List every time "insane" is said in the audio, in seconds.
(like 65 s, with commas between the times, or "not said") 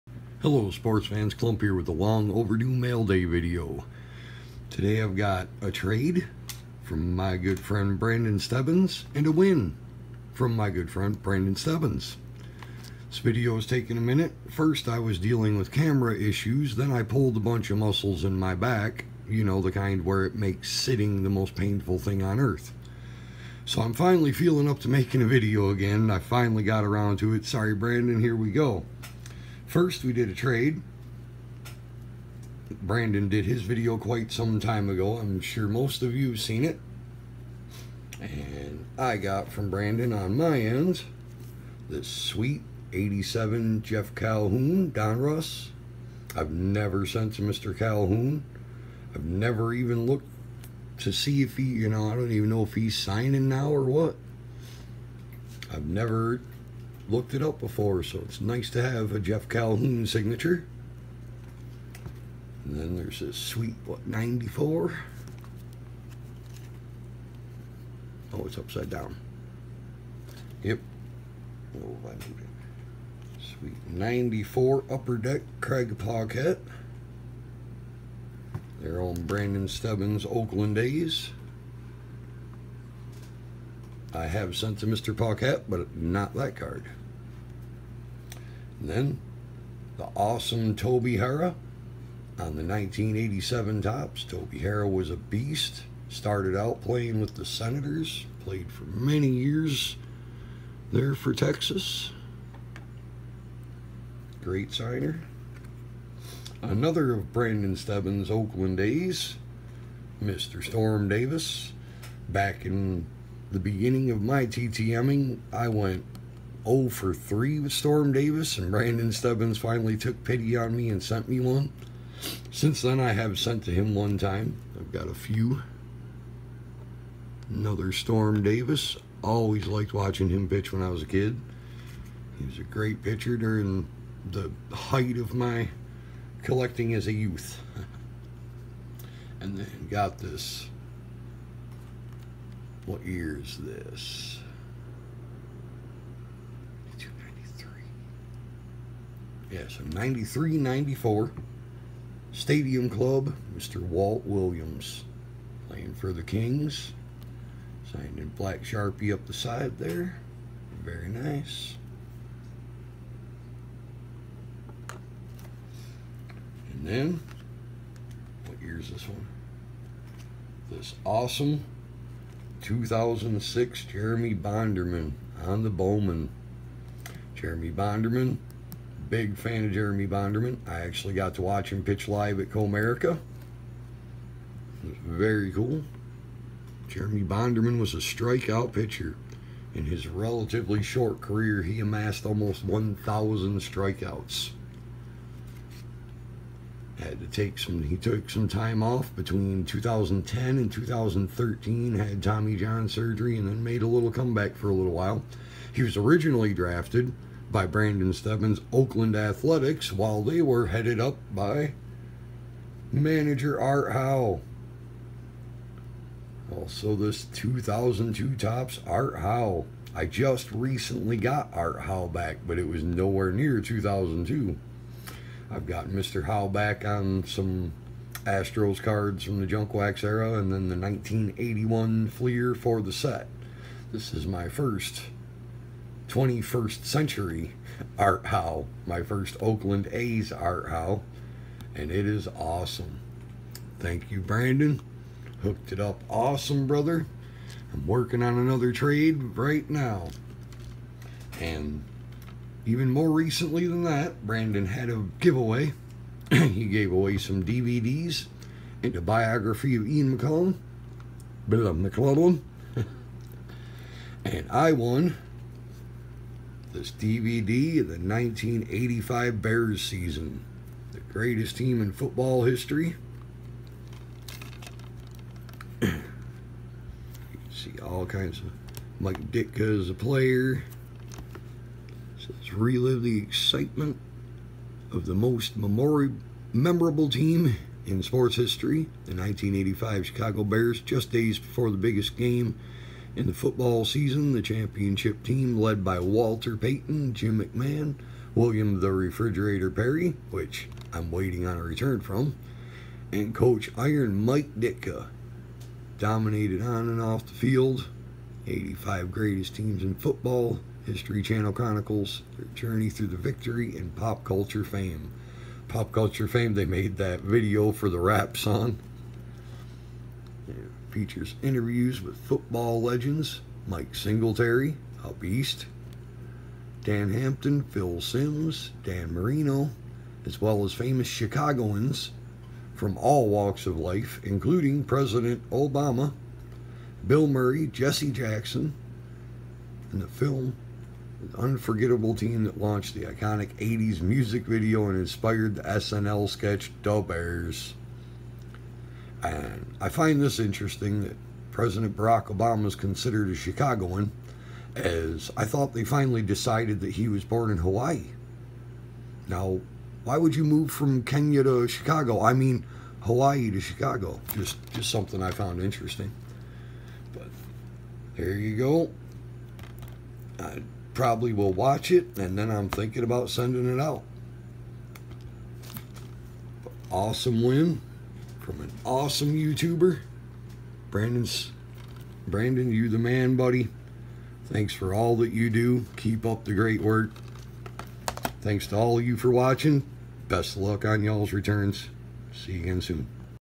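not said.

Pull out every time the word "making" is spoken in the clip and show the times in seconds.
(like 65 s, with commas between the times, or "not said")
24 s.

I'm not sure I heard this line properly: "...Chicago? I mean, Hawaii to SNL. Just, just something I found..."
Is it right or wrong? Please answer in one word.
wrong.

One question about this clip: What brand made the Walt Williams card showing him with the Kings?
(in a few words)
Stadium Club.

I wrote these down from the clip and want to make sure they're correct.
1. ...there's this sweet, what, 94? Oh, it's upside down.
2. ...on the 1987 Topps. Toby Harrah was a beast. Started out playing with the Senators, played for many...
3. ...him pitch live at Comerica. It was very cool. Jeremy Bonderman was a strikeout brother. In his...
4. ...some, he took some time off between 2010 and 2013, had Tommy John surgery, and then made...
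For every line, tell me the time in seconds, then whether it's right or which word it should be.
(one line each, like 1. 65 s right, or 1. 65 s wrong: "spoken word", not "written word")
1. 62 s right
2. 92 s right
3. 181 s wrong: "pitcher", not "brother"
4. 197 s right.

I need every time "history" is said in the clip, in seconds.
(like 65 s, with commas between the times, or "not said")
272 s, 288 s, 310 s.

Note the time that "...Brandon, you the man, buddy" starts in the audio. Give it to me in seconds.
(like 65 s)
382 s.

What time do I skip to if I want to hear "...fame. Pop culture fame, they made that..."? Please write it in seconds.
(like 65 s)
314 s.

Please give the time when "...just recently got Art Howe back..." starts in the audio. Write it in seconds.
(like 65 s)
220 s.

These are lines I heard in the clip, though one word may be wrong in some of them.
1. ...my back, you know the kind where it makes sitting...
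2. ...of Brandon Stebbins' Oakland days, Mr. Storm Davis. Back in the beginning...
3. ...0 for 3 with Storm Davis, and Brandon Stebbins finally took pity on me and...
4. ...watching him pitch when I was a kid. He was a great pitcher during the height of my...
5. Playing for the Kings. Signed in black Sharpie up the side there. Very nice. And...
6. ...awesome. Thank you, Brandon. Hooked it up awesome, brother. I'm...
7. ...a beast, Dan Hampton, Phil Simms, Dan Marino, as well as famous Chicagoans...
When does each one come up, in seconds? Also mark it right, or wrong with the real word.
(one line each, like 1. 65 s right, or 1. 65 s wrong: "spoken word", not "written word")
1. 18 s right
2. 107 s right
3. 116 s right
4. 129 s right
5. 155 s right
6. 242 s right
7. 325 s right.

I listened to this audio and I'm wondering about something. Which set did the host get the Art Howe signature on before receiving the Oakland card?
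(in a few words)
1981 Fleer.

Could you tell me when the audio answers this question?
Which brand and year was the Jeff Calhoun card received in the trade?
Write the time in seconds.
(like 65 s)
42 s.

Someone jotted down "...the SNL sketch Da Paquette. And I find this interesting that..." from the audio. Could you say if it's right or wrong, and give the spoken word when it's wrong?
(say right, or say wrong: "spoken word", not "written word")
wrong: "Bears", not "Paquette".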